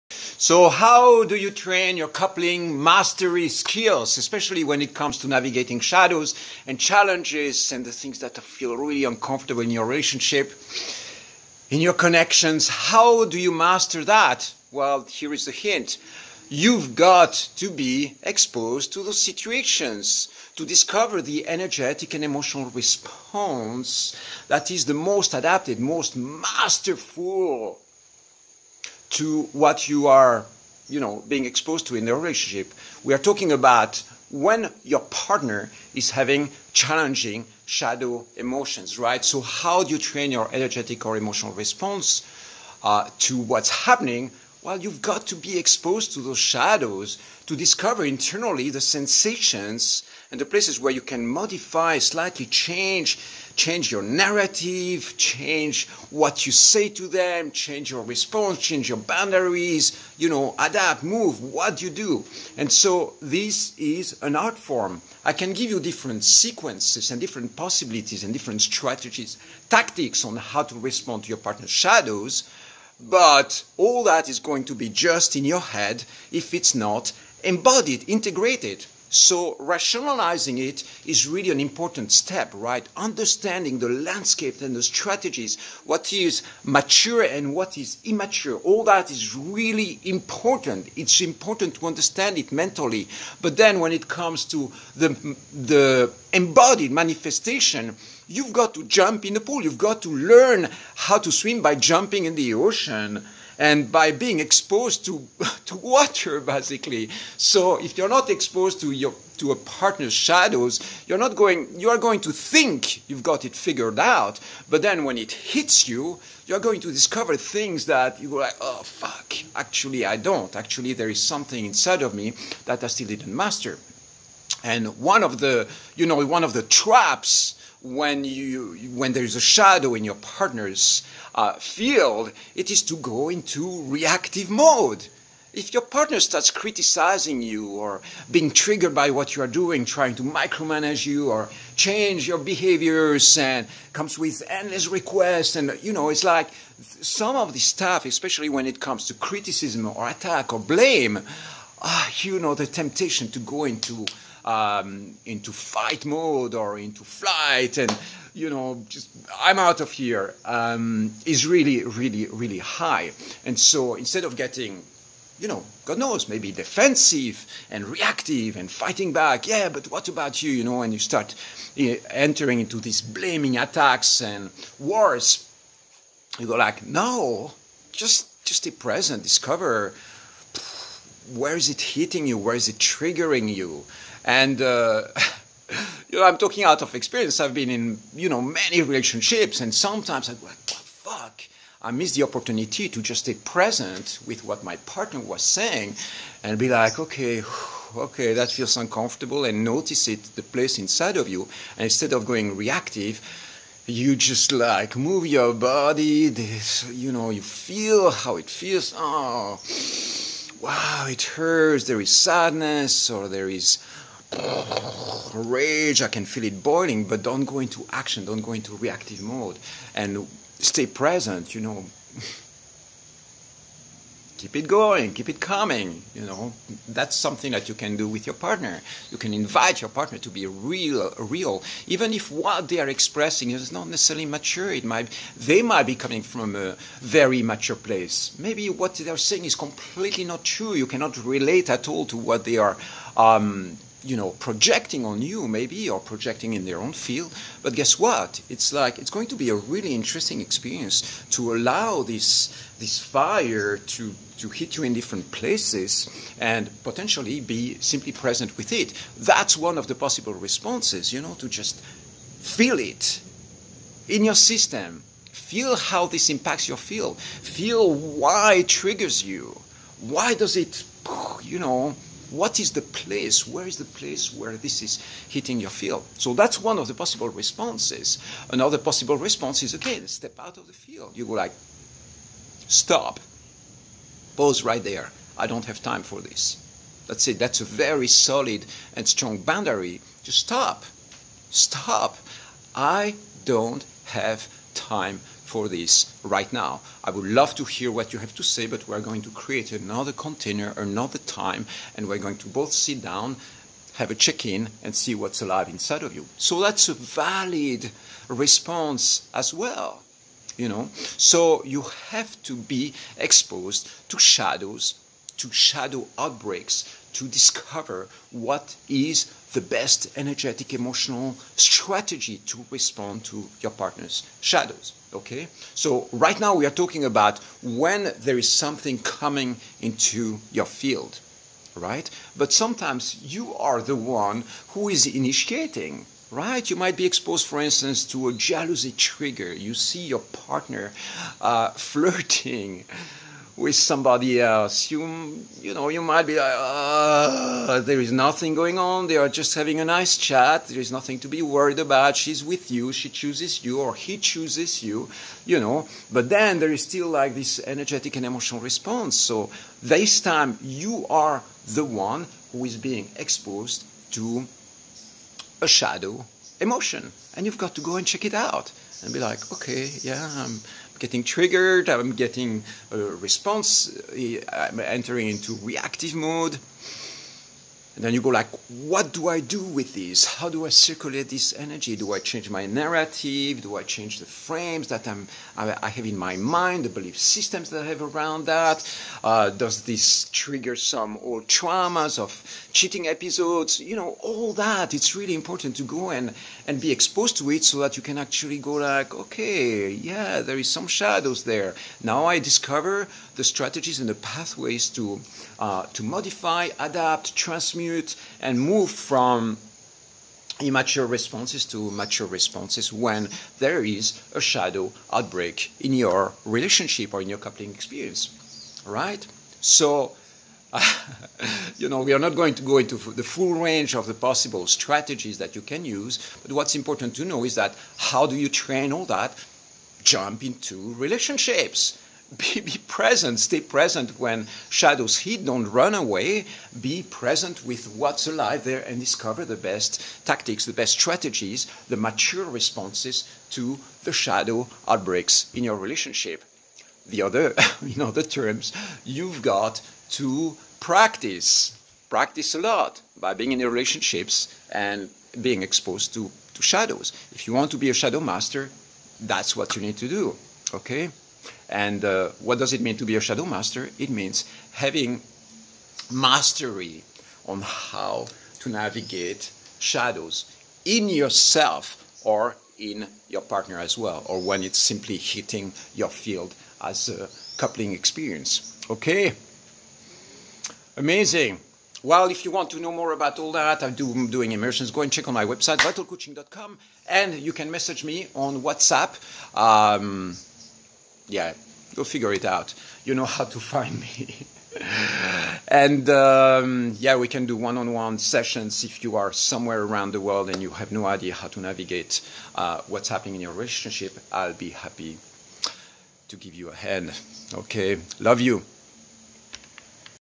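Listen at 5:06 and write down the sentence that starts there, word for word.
So that's a valid response as well.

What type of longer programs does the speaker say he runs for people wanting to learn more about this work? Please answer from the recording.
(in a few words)
immersions.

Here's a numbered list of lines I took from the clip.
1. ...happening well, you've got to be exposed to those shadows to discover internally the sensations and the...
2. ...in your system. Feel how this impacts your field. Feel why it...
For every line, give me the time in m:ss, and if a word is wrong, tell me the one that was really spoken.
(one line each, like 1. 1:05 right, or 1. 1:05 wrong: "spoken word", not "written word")
1. 0:43 right
2. 4:24 right.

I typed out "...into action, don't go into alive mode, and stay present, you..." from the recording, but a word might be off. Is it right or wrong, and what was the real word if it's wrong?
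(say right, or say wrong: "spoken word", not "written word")
wrong: "reactive", not "alive".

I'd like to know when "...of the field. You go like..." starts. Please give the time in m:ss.
4:40.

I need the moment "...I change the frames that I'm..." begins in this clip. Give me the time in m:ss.
6:23.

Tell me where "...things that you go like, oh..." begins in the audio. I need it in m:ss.
1:57.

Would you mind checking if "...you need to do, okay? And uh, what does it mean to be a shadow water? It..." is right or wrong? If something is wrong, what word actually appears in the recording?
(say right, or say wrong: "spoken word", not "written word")
wrong: "master", not "water".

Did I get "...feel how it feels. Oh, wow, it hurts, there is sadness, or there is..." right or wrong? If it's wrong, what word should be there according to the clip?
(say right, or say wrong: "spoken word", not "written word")
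right.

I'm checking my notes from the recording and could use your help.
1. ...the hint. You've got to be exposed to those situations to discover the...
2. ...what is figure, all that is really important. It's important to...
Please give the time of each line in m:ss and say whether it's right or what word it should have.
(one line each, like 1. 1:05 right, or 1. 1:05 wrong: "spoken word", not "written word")
1. 0:15 right
2. 1:27 wrong: "immature", not "figure".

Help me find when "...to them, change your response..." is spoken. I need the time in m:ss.
0:56.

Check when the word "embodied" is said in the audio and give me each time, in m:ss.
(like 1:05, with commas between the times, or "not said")
1:17, 1:36.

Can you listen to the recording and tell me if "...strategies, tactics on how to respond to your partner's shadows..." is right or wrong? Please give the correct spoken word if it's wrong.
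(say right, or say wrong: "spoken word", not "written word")
right.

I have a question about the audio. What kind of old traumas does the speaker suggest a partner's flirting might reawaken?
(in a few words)
cheating episodes.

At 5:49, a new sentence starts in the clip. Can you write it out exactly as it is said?
They are just having a nice chat.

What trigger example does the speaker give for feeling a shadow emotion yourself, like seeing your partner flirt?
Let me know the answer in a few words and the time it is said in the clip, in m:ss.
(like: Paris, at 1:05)
jealousy trigger, at 5:38.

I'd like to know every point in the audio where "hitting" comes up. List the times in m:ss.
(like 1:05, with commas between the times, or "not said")
3:01, 4:35, 7:55.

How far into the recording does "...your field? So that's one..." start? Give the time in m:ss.
4:35.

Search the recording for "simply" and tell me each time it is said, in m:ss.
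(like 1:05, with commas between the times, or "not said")
4:17, 7:54.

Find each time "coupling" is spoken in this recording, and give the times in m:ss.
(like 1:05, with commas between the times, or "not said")
0:02, 6:57, 7:57.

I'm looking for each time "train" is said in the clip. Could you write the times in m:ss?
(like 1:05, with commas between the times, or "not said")
0:01, 0:39, 7:08.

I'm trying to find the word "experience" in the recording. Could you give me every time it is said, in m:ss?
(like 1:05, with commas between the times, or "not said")
3:06, 4:10, 6:57, 7:57.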